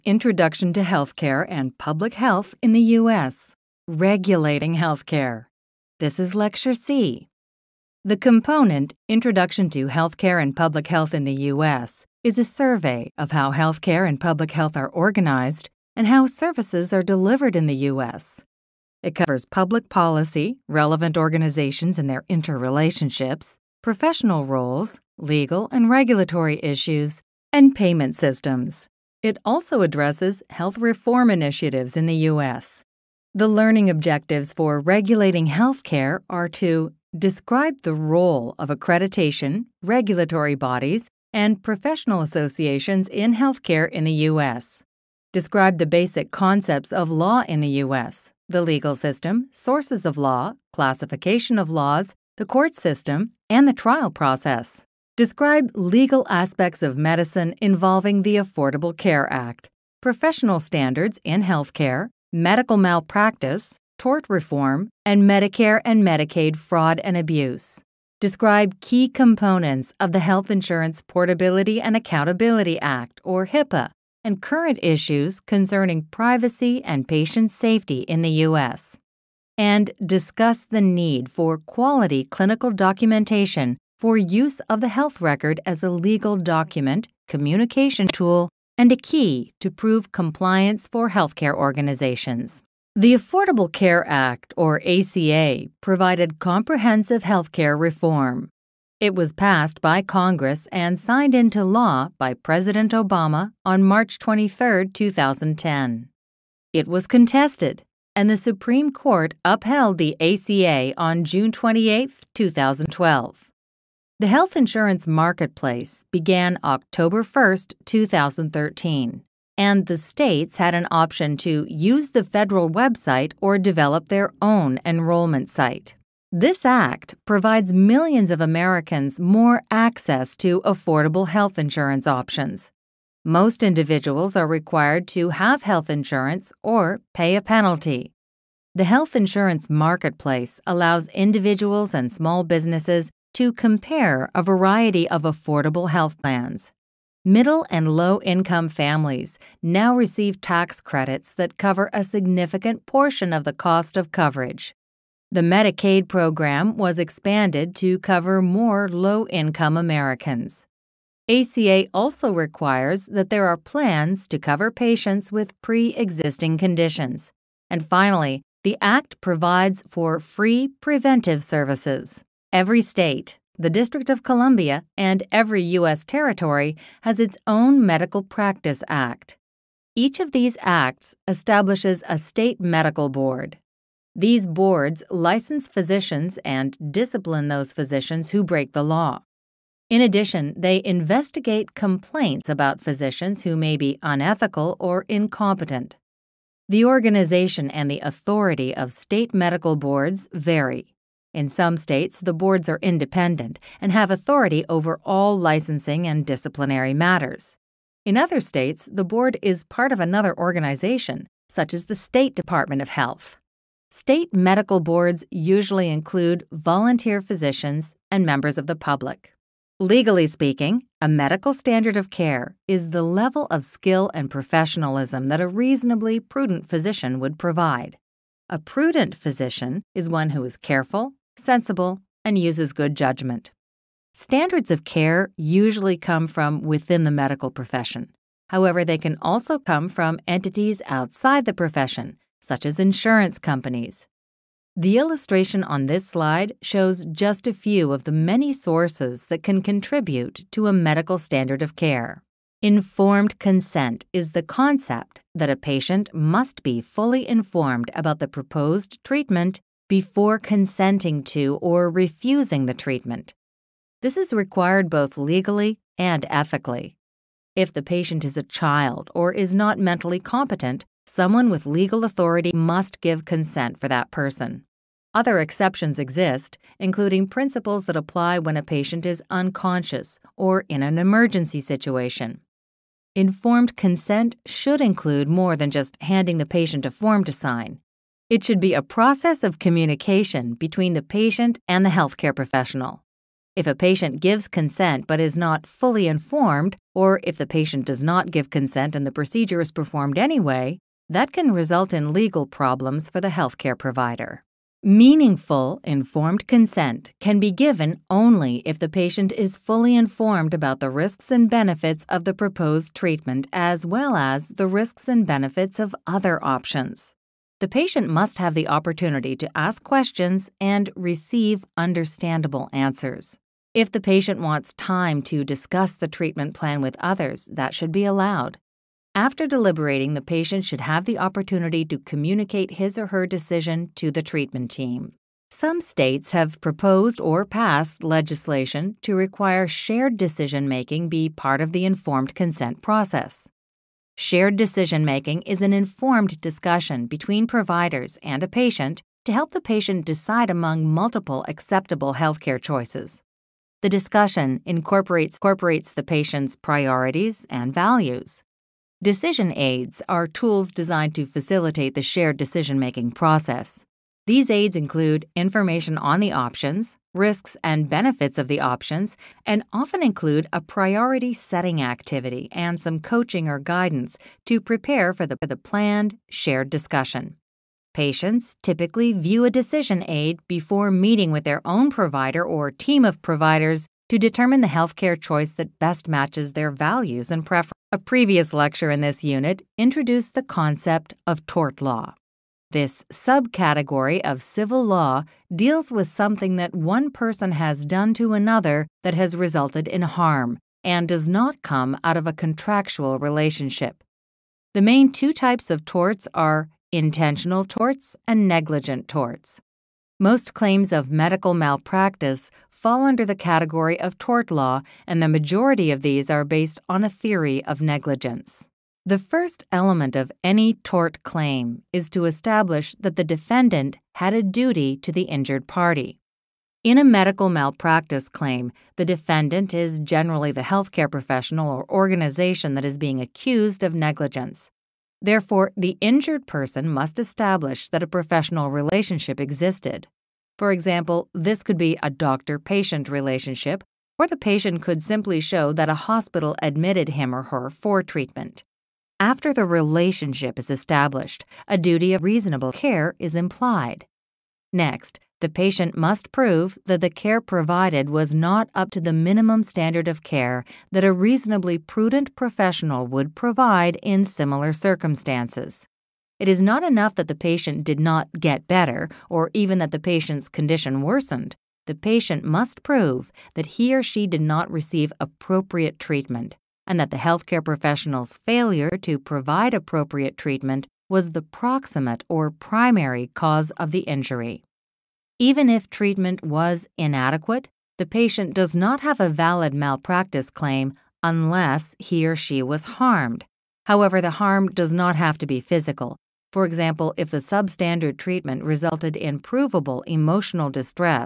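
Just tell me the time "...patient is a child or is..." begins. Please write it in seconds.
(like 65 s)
267 s.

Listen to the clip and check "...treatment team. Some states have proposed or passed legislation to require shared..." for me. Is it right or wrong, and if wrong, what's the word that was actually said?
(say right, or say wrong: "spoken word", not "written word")
right.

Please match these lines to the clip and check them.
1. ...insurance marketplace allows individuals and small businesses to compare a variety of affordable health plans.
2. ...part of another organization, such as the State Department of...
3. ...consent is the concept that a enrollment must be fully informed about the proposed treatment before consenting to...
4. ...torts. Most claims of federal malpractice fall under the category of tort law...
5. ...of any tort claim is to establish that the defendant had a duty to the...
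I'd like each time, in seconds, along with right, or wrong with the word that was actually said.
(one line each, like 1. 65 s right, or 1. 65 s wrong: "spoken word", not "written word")
1. 139 s right
2. 209 s right
3. 253 s wrong: "patient", not "enrollment"
4. 409 s wrong: "medical", not "federal"
5. 420 s right.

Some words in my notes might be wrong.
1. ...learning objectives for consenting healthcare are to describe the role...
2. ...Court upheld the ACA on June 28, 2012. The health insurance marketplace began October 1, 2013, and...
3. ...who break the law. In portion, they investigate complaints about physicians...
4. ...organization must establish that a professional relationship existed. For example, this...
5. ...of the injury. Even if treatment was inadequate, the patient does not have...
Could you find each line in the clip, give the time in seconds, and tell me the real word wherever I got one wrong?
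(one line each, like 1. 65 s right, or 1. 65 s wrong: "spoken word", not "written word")
1. 33 s wrong: "regulating", not "consenting"
2. 108 s right
3. 188 s wrong: "addition", not "portion"
4. 436 s wrong: "person", not "organization"
5. 483 s right.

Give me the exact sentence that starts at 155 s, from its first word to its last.
The Medicaid program was expanded to cover more low income Americans.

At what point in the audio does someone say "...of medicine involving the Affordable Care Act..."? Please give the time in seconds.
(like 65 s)
56 s.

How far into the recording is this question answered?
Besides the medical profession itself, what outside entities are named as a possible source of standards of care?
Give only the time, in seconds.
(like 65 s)
242 s.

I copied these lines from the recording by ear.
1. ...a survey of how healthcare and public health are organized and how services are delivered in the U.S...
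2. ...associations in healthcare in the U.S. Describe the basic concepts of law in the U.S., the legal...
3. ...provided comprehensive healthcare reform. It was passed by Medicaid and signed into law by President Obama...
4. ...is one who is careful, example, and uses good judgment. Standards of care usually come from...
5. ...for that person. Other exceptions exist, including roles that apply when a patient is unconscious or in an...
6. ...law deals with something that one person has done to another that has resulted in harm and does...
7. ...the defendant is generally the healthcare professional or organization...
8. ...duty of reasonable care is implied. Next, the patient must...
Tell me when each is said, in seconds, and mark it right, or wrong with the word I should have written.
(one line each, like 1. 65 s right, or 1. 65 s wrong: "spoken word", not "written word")
1. 12 s right
2. 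42 s right
3. 95 s wrong: "Congress", not "Medicaid"
4. 229 s wrong: "sensible", not "example"
5. 273 s wrong: "principles", not "roles"
6. 394 s right
7. 428 s right
8. 451 s right.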